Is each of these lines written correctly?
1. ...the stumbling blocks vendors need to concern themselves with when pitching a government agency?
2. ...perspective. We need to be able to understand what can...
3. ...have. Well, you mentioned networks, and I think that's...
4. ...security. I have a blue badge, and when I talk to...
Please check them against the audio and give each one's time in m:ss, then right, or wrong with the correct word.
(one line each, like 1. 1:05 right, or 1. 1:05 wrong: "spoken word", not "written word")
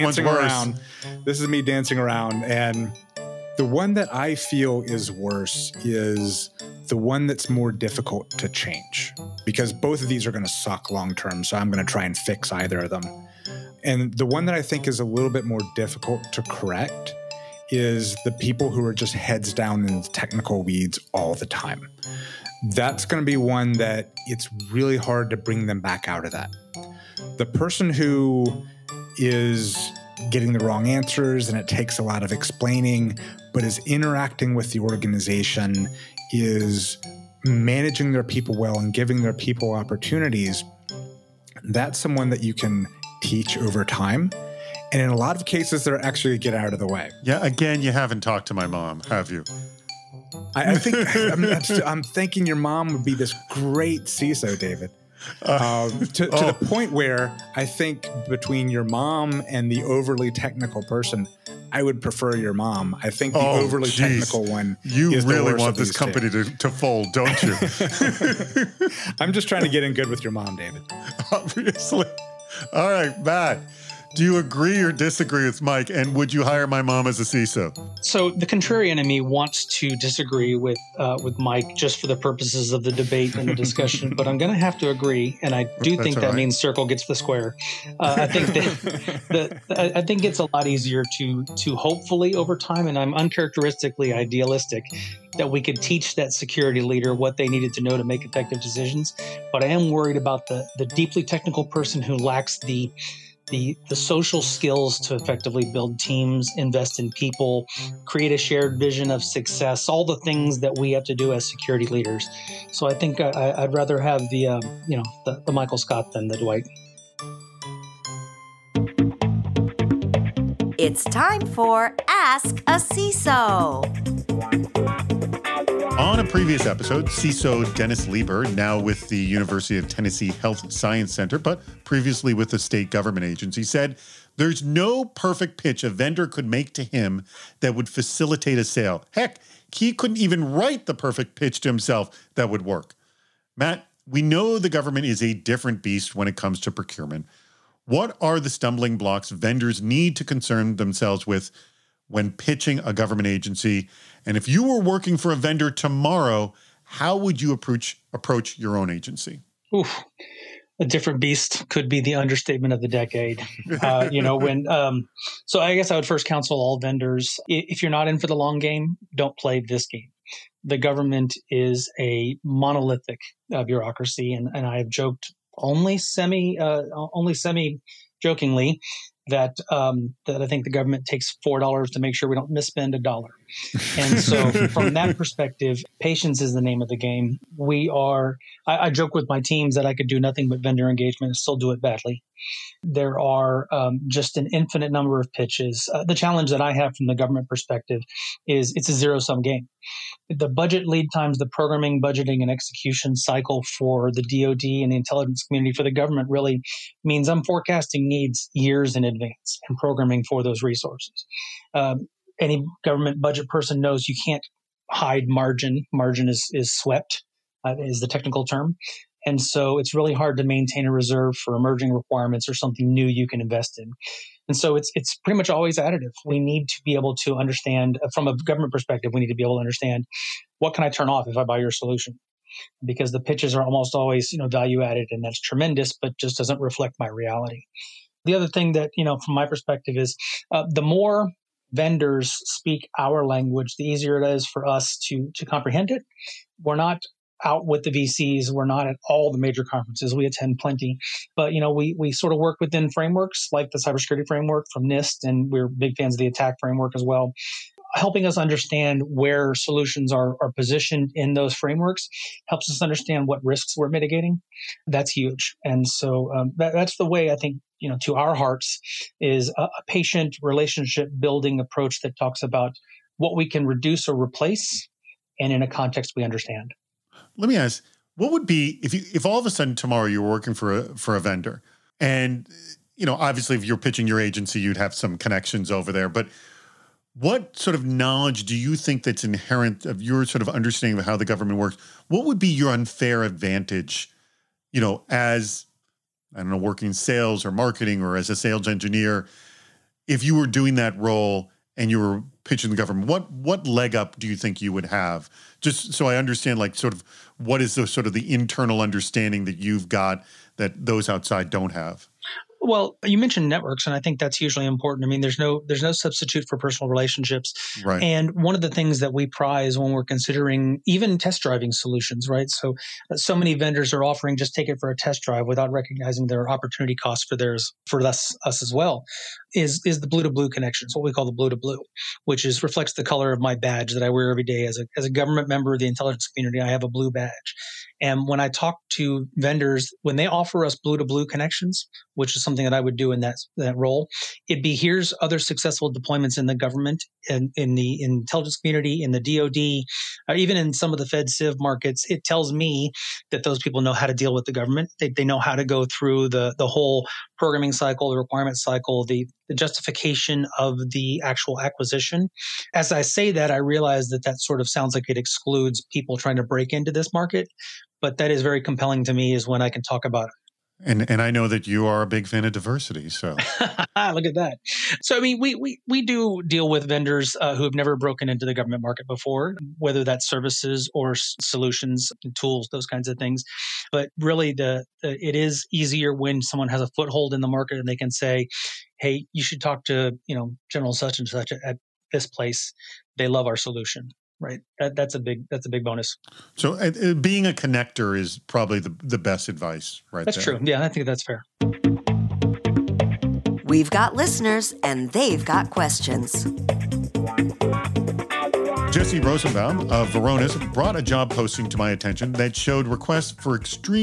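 1. 2:28 right
2. 3:48 right
3. 5:11 right
4. 5:36 wrong: "community", not "security".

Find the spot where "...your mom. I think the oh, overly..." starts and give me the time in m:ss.
1:02.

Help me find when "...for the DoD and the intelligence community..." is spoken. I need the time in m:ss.
3:23.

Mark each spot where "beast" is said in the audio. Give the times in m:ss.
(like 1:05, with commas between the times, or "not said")
2:25, 2:41.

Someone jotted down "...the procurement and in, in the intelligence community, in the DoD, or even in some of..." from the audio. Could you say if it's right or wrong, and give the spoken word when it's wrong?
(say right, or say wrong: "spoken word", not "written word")
wrong: "government", not "procurement".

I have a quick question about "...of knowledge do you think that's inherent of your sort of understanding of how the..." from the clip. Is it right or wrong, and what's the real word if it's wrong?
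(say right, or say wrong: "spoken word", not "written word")
right.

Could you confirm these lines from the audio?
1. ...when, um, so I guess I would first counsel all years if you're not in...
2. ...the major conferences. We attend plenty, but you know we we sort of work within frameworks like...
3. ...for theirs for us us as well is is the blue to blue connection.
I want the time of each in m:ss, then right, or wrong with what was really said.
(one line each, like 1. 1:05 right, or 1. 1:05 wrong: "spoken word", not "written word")
1. 2:44 wrong: "vendors", not "years"
2. 4:09 right
3. 5:27 right.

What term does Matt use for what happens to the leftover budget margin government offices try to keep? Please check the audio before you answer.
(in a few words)
Swept.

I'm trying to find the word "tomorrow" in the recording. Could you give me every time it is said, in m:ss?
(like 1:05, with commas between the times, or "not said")
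2:35, 4:39.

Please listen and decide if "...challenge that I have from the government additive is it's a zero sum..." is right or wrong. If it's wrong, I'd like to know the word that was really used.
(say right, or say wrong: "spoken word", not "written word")
wrong: "perspective", not "additive".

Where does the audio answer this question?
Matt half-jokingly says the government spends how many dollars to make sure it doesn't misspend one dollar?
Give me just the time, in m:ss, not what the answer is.
3:01.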